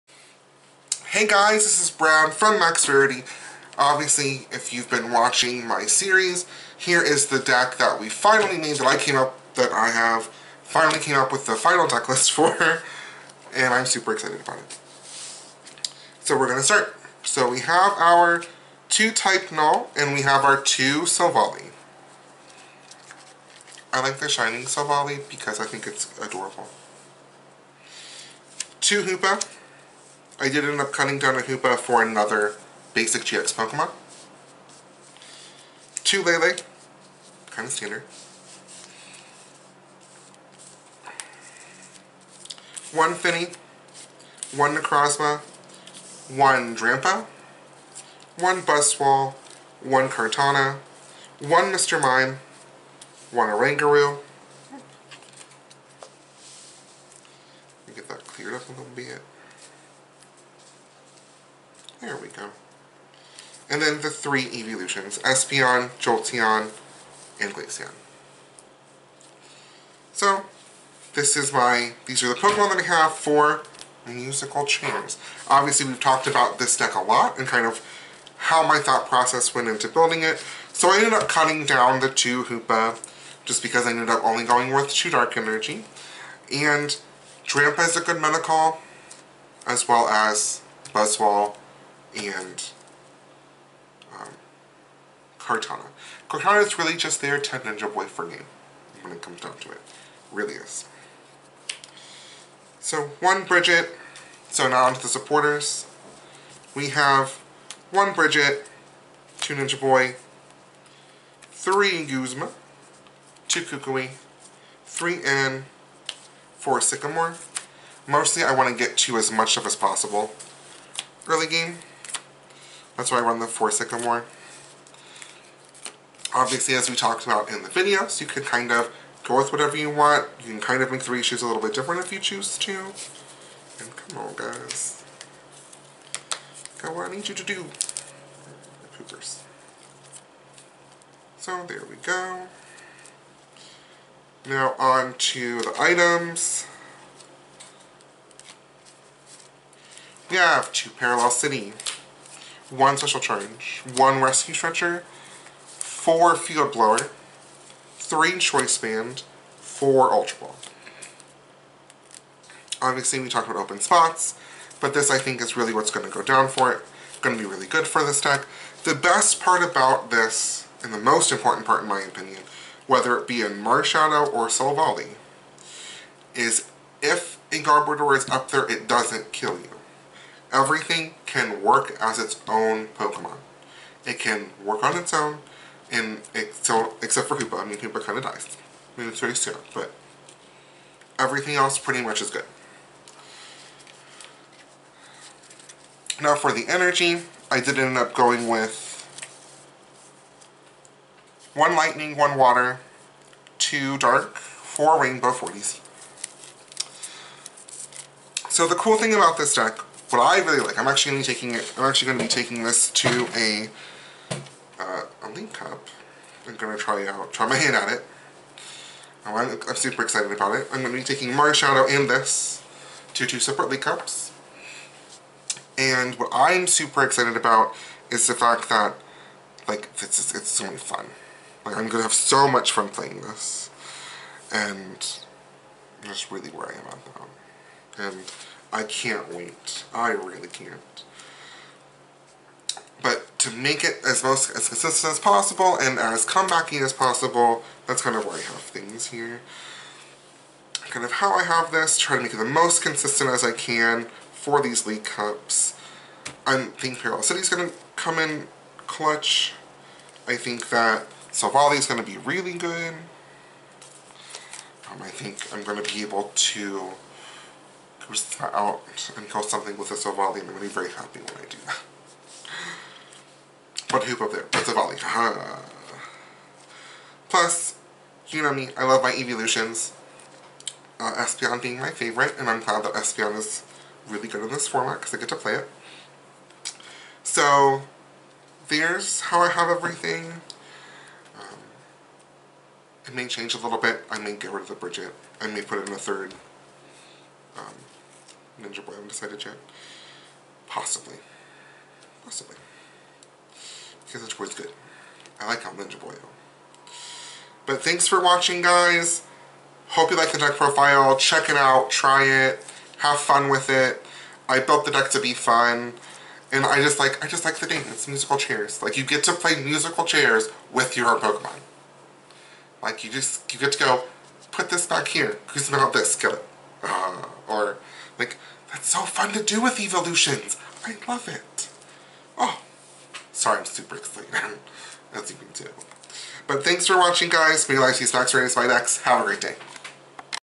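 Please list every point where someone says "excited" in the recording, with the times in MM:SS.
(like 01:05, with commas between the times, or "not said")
00:14, 03:40, 03:47, 05:33.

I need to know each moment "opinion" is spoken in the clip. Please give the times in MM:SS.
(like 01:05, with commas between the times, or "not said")
02:52.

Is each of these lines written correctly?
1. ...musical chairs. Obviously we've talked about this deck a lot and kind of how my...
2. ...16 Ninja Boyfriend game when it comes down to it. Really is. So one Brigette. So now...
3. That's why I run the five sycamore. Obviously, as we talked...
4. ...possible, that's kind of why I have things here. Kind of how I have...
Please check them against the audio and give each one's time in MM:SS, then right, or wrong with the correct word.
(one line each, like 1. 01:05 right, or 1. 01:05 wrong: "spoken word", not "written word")
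1. 01:14 right
2. 01:37 wrong: "10", not "16"
3. 02:02 wrong: "four", not "five"
4. 04:06 right.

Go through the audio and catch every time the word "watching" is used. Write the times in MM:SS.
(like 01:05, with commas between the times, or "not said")
00:05, 05:08, 05:36.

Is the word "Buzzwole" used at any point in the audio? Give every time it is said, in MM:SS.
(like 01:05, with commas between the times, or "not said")
00:48, 01:30.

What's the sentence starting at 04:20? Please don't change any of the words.
I think that is going to be really good.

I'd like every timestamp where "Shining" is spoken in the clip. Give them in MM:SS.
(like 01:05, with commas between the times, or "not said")
00:24.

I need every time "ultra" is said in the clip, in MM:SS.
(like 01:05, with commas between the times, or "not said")
02:40.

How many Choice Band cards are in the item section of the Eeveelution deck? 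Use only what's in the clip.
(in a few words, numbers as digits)
3.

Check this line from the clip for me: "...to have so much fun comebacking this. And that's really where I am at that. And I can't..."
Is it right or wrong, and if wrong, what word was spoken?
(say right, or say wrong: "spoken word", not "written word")
wrong: "playing", not "comebacking".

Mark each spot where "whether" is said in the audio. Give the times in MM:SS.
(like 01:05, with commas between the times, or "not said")
02:52.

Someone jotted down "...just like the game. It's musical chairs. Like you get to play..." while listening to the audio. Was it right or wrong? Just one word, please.
right.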